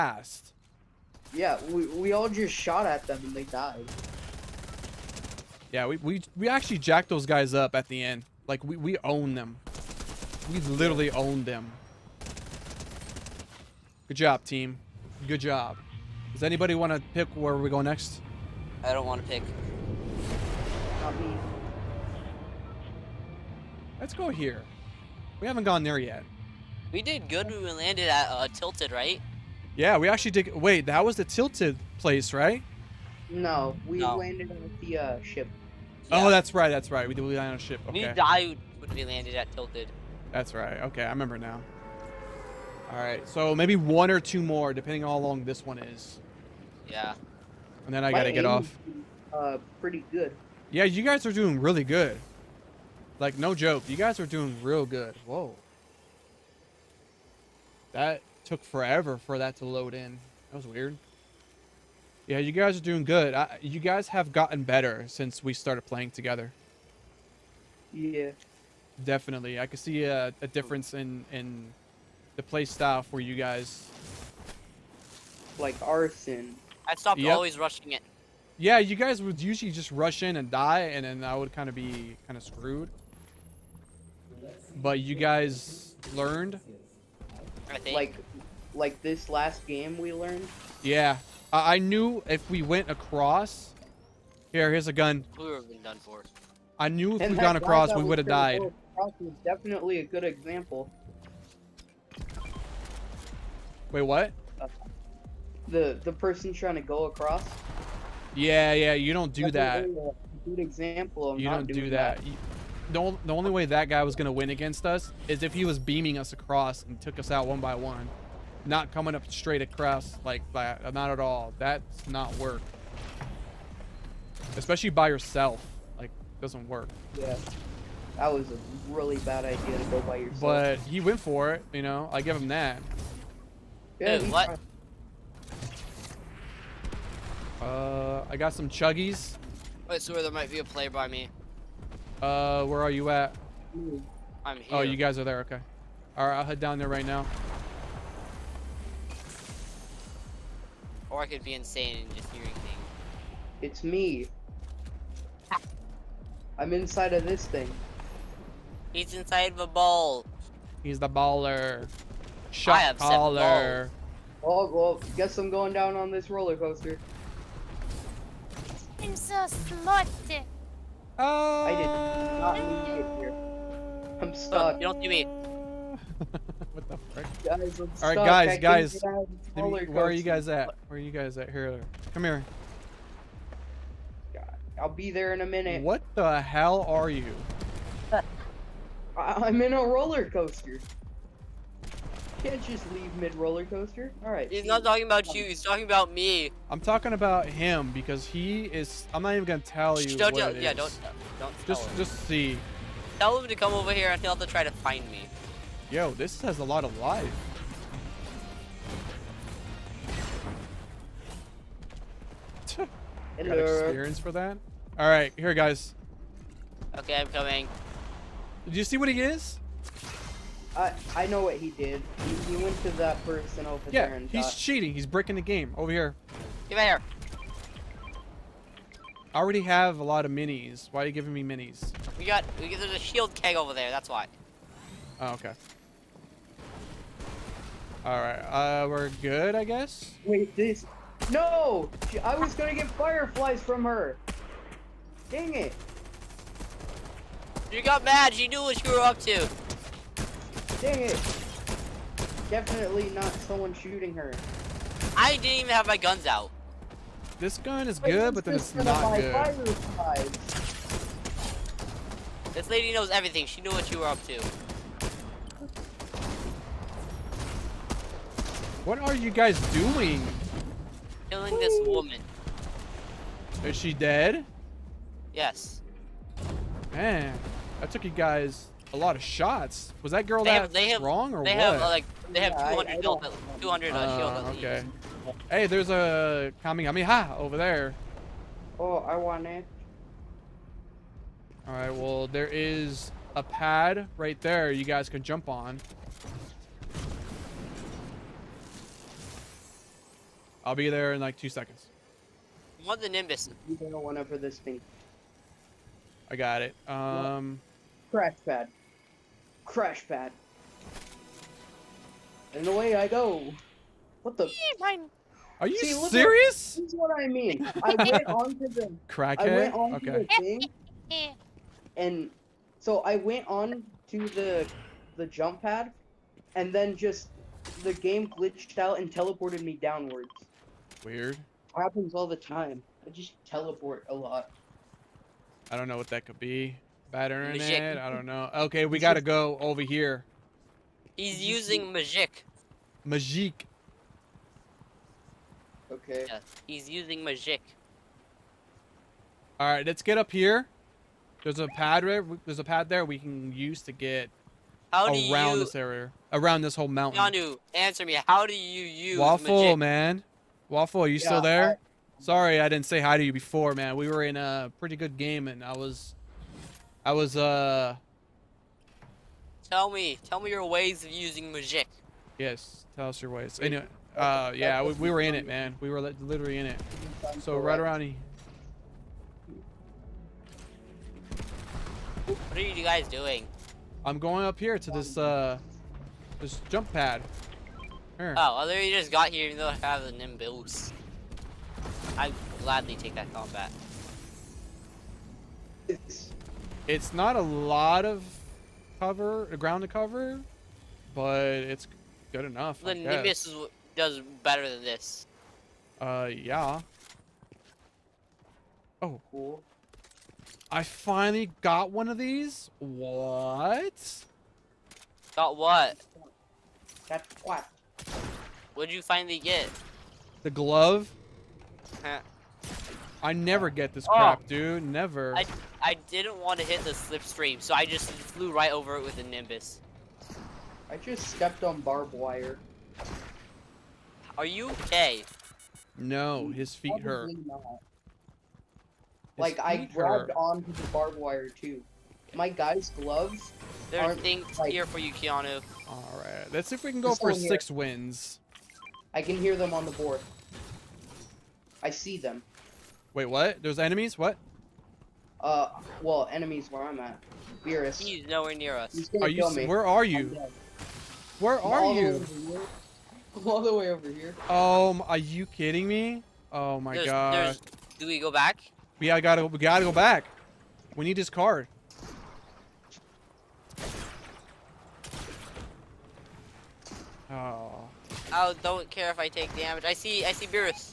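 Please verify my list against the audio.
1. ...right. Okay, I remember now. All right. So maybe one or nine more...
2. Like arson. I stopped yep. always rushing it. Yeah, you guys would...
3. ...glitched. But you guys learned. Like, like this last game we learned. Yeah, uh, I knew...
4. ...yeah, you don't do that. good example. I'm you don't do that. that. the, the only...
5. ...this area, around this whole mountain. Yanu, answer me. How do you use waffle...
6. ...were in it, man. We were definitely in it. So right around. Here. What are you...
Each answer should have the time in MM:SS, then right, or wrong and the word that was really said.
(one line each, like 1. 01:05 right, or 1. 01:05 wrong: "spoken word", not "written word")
1. 00:40 wrong: "two", not "nine"
2. 01:15 right
3. 01:22 wrong: "screwed", not "glitched"
4. 01:48 right
5. 05:55 right
6. 06:15 wrong: "literally", not "definitely".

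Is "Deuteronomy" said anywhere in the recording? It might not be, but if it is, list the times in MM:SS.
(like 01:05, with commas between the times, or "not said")
not said.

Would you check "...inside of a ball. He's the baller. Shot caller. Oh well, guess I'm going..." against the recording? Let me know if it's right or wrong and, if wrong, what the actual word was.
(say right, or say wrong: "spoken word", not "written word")
right.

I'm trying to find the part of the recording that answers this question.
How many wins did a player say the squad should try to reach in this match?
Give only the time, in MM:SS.
07:27.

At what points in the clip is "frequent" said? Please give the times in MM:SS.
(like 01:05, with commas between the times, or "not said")
not said.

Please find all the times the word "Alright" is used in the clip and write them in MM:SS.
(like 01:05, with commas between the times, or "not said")
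02:26, 03:34, 07:25.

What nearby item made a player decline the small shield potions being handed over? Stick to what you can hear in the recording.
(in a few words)
Shield keg.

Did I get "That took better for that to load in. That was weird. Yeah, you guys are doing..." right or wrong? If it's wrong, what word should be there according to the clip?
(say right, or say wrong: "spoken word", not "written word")
wrong: "forever", not "better".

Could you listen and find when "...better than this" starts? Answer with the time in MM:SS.
06:44.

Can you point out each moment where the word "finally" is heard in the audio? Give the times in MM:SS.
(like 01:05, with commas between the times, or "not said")
06:50, 06:59.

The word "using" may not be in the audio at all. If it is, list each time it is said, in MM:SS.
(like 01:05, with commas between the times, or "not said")
05:41, 05:46, 06:11.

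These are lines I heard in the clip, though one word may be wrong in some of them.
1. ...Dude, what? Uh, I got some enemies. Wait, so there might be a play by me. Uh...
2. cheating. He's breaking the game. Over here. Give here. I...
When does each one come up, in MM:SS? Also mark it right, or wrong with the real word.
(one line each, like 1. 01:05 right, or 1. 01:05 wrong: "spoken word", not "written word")
1. 02:14 wrong: "chuggies", not "enemies"
2. 03:44 right.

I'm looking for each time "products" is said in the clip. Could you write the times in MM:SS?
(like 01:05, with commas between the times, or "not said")
not said.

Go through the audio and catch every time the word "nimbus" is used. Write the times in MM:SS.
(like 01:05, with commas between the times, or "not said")
05:03, 06:30, 06:42, 07:09.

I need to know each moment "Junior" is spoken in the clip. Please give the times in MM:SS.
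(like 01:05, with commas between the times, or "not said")
not said.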